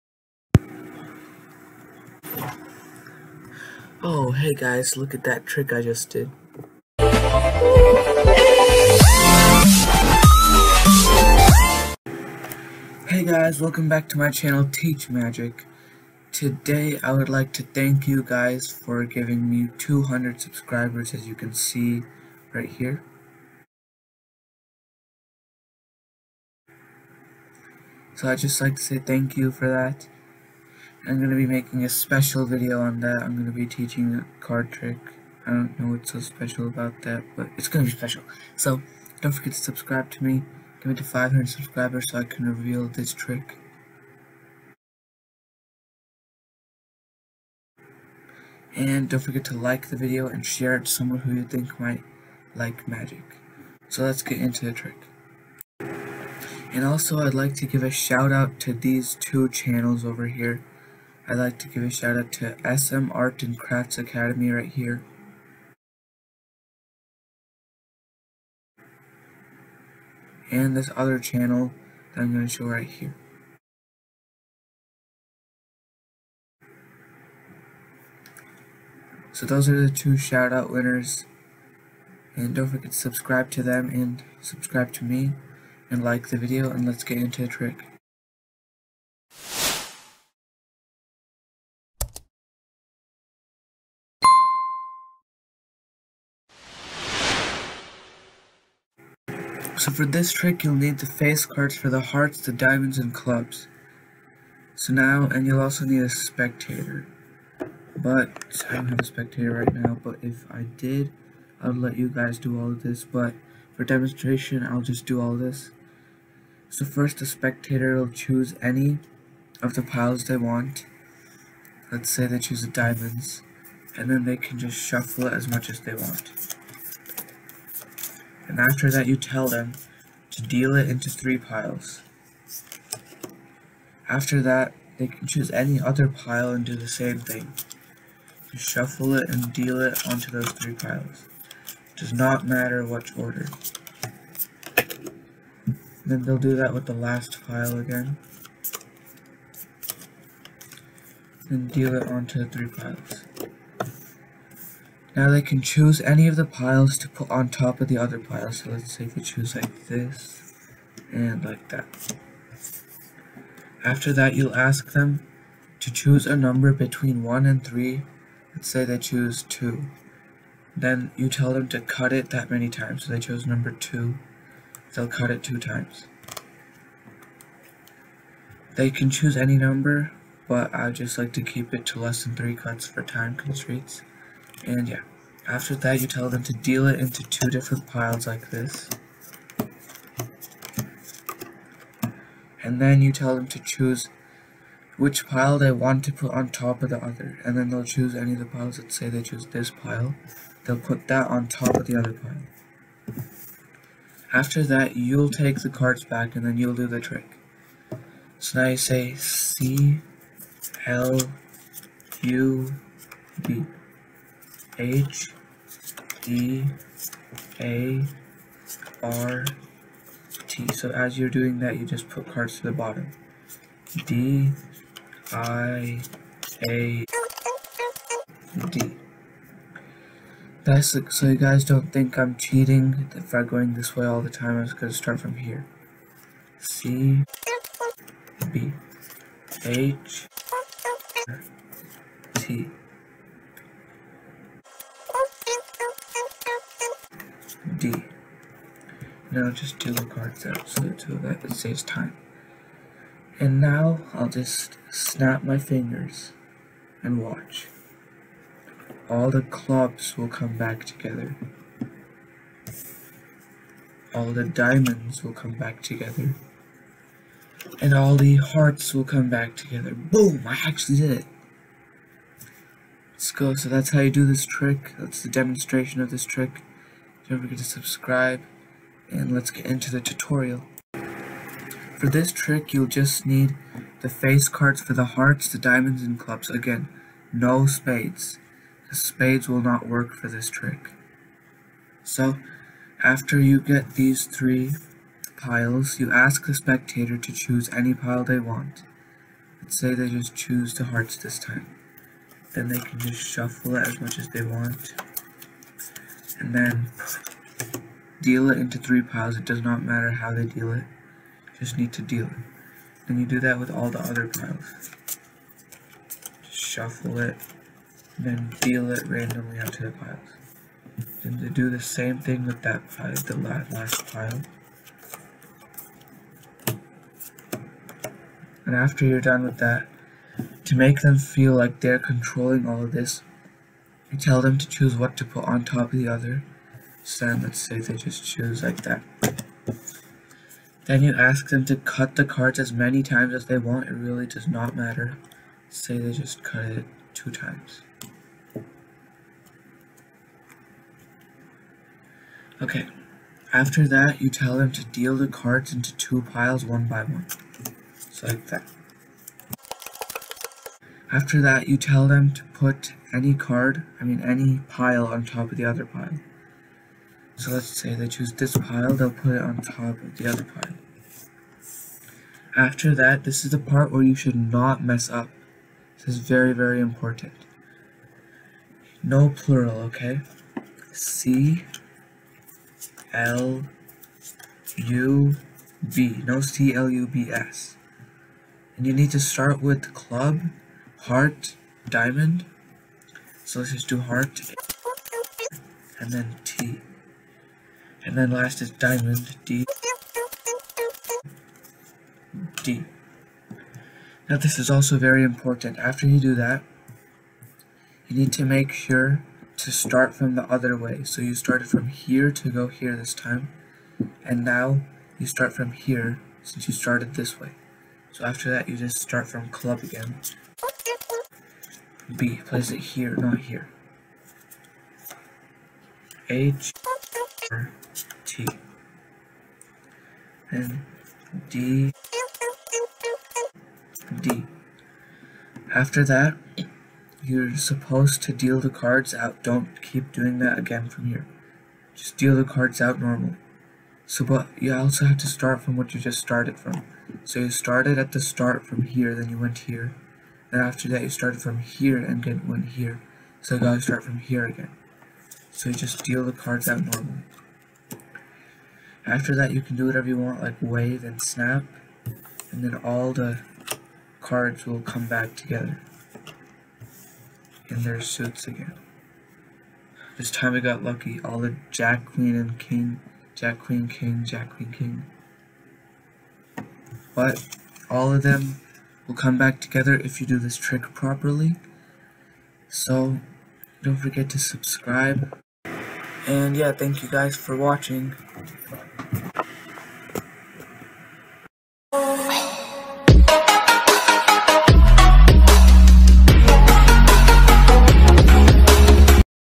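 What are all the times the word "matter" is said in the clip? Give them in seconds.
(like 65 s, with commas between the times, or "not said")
142 s, 309 s, 344 s.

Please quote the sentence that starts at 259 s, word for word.
All the clubs will come back together.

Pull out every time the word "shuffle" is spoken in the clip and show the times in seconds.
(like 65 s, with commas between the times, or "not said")
124 s, 138 s, 303 s, 316 s.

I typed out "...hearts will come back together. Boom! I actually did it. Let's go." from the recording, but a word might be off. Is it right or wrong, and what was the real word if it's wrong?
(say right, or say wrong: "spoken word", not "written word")
right.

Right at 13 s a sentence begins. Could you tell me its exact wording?
Hey guys, welcome back to my channel Teach Magic.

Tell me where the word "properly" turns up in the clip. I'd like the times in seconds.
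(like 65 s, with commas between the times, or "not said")
480 s.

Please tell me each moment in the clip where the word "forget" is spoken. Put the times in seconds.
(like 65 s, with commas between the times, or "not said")
39 s, 49 s, 82 s, 277 s, 483 s.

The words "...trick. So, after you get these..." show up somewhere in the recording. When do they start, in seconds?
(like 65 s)
290 s.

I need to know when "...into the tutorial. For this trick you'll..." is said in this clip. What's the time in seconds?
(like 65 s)
279 s.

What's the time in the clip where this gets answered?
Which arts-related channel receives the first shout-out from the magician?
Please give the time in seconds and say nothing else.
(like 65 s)
62 s.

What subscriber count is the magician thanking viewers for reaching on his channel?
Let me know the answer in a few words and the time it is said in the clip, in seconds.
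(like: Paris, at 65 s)
200, at 19 s.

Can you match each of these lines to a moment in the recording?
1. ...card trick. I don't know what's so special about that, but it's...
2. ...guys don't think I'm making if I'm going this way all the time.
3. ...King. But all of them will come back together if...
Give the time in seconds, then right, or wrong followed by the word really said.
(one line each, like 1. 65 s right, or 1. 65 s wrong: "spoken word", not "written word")
1. 34 s right
2. 231 s wrong: "cheating", not "making"
3. 474 s right.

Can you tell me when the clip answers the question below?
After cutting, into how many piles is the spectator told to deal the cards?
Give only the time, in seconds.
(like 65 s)
187 s.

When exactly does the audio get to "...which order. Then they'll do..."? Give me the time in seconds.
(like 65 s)
142 s.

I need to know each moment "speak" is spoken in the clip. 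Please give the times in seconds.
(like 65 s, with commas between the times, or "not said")
not said.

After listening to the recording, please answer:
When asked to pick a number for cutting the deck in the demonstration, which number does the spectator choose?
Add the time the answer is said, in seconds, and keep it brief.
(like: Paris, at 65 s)
2, at 168 s.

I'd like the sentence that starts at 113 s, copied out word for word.
But for demonstration, I'll just do all this.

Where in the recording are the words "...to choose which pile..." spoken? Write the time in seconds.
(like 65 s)
193 s.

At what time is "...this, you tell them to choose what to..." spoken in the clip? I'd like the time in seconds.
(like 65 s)
332 s.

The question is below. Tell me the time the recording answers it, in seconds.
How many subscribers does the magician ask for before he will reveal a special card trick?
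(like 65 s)
41 s.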